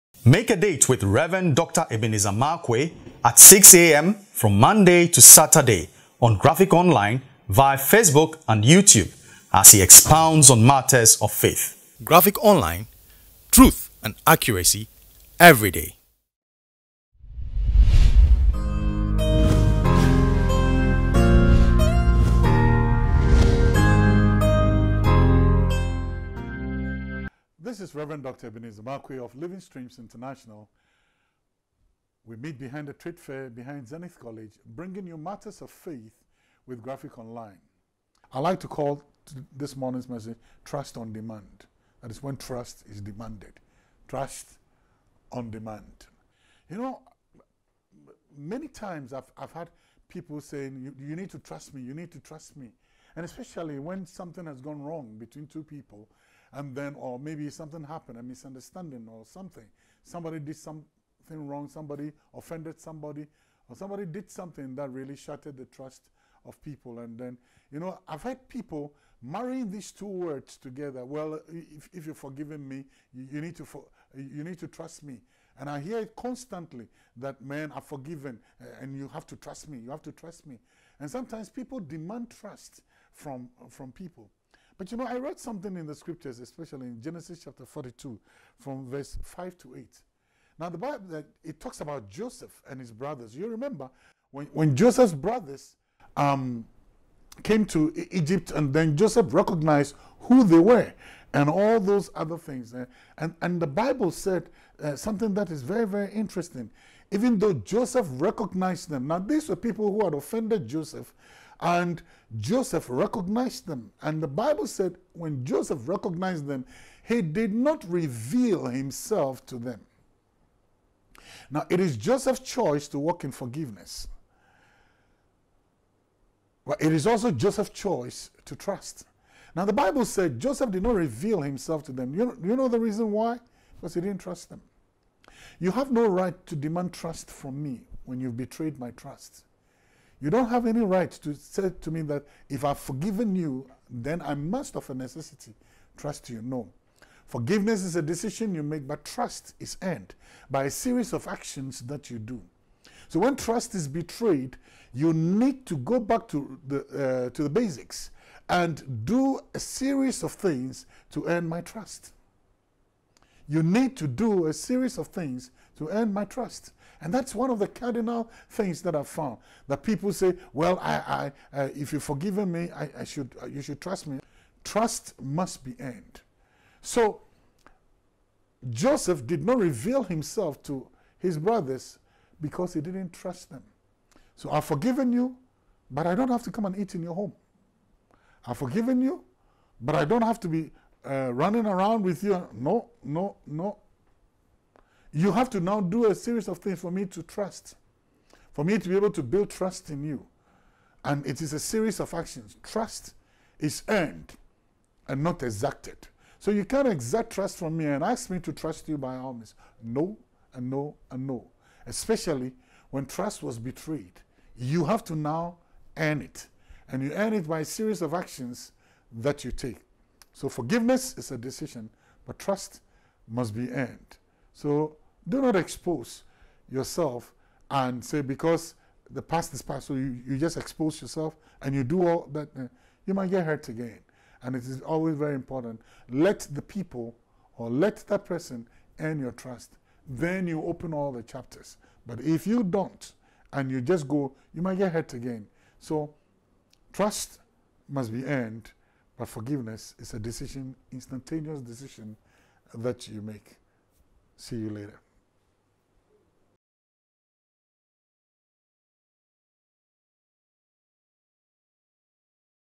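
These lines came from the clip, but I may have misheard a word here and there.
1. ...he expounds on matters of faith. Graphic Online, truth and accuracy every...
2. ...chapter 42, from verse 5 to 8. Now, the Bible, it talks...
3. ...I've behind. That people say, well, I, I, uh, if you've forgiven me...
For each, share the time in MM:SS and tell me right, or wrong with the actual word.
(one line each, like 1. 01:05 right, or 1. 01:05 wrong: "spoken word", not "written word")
1. 00:09 right
2. 01:27 right
3. 02:48 wrong: "found", not "behind".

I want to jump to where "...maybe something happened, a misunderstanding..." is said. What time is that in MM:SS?
00:57.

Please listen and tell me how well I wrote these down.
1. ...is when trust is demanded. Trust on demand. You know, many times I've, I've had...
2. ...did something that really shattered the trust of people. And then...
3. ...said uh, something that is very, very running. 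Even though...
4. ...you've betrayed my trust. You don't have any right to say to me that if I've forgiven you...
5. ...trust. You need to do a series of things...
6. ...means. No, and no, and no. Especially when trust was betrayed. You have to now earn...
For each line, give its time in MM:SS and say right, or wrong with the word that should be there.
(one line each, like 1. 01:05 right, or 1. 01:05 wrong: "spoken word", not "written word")
1. 00:42 right
2. 01:04 right
3. 01:44 wrong: "interesting", not "running"
4. 02:18 right
5. 02:41 right
6. 03:29 right.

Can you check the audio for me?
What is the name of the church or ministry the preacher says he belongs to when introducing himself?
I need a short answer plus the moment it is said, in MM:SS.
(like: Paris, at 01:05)
Living Streams International, at 00:29.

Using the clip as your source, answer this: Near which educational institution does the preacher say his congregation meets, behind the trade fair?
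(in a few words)
Zenith College.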